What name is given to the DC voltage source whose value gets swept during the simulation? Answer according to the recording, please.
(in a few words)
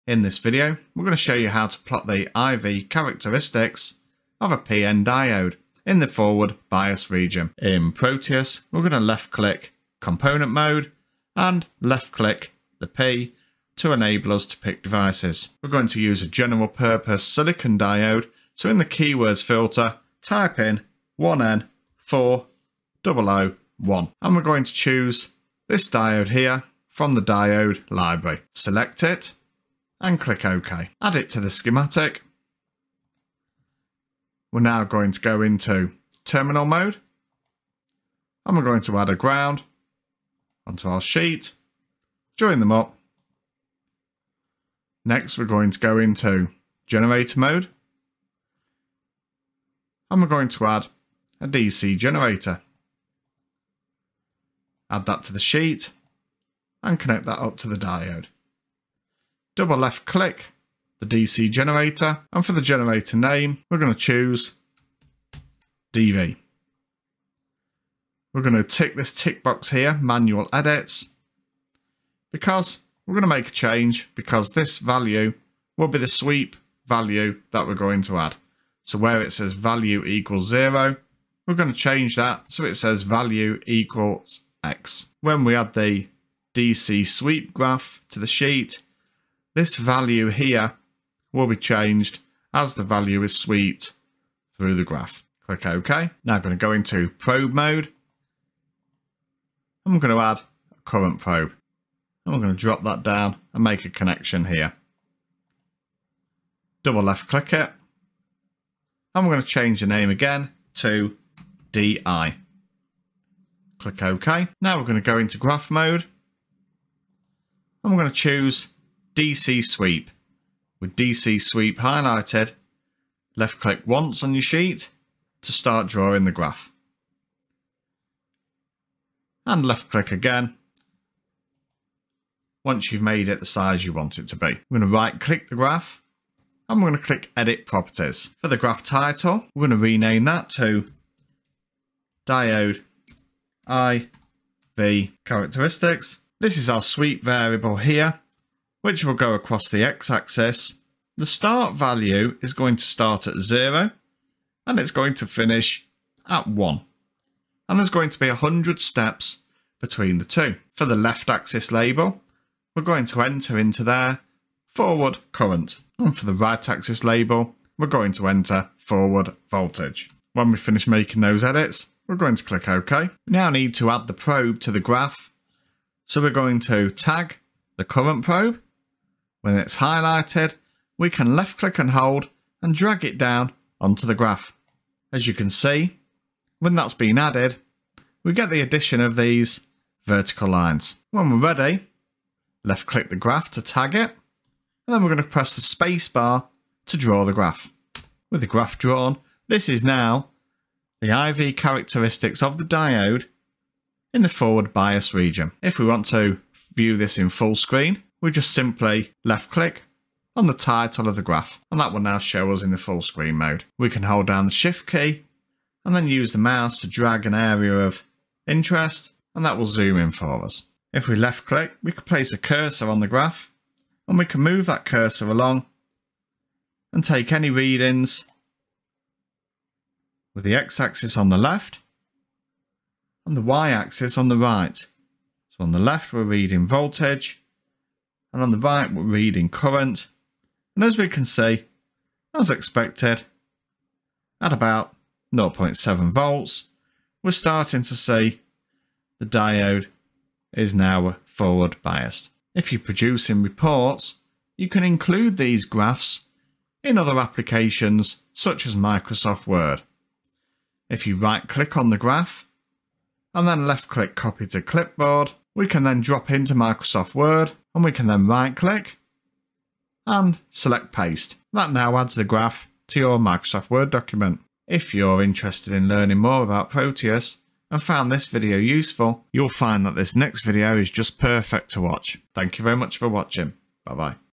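DV.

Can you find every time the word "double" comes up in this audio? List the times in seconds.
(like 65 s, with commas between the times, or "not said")
59 s, 106 s.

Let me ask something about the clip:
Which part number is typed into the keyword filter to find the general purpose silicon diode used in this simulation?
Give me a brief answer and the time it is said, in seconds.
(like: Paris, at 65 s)
1N4001, at 21 s.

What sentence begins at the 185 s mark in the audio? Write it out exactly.
As you can see, when that's been added, we get the addition of these vertical lines.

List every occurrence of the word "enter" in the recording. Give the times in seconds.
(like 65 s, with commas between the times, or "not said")
163 s, 168 s.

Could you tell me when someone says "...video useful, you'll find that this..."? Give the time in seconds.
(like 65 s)
278 s.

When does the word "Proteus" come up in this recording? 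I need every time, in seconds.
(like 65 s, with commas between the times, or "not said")
7 s, 276 s.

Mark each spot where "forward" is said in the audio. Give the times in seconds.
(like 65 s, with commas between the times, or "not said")
6 s, 164 s, 168 s, 204 s, 251 s.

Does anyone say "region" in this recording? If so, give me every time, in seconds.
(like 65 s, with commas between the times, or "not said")
7 s, 205 s.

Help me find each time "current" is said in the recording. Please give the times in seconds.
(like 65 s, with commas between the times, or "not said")
100 s, 165 s, 177 s, 239 s.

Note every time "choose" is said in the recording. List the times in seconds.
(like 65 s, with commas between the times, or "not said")
24 s, 63 s, 118 s.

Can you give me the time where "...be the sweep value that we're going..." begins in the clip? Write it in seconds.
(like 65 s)
75 s.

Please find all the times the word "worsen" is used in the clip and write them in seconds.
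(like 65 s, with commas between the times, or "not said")
not said.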